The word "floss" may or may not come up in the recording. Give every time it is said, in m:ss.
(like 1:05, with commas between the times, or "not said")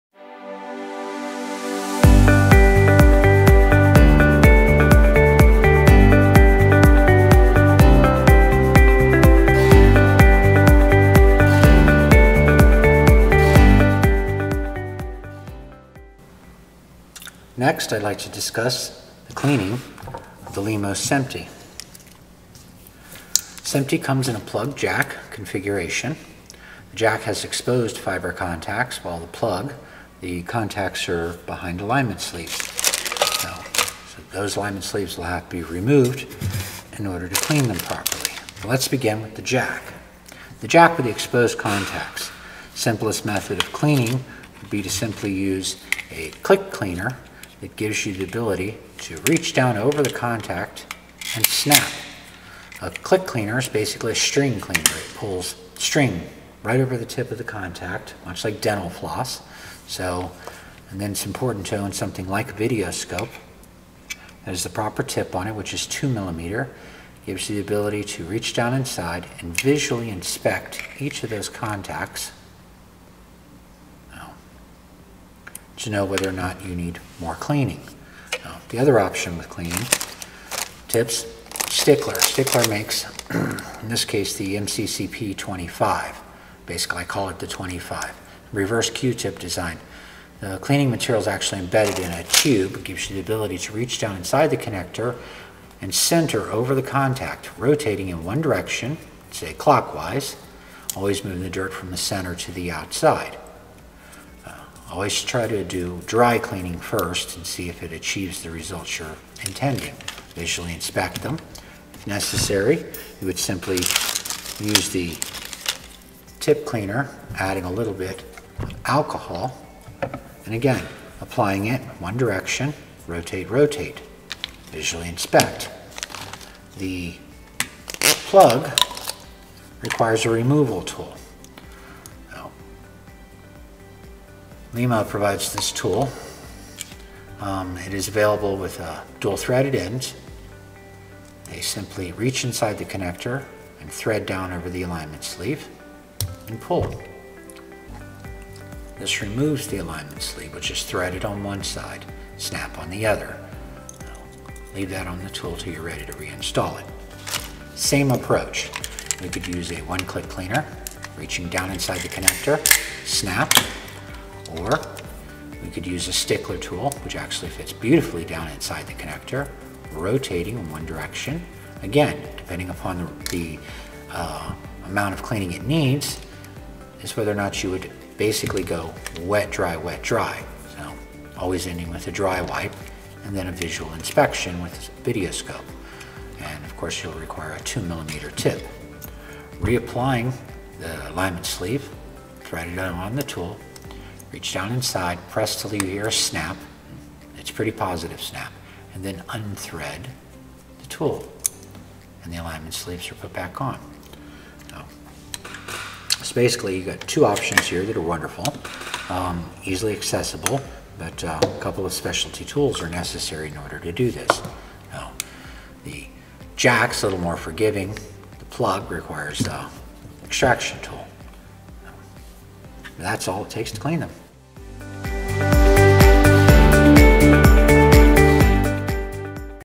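0:58.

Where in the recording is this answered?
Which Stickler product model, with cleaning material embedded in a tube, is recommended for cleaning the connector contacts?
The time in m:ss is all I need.
1:24.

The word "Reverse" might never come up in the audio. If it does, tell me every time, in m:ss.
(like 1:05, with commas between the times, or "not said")
1:28.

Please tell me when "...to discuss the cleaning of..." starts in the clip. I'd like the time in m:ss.
0:18.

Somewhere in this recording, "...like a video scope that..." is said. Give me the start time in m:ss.
1:02.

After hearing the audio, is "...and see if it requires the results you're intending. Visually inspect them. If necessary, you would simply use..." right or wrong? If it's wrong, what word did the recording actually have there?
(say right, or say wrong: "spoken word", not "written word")
wrong: "achieves", not "requires".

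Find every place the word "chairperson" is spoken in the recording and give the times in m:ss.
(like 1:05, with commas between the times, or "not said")
not said.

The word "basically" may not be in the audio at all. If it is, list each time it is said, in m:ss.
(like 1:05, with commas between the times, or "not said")
0:53, 1:26, 2:58, 3:26.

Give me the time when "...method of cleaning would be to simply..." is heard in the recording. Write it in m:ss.
0:43.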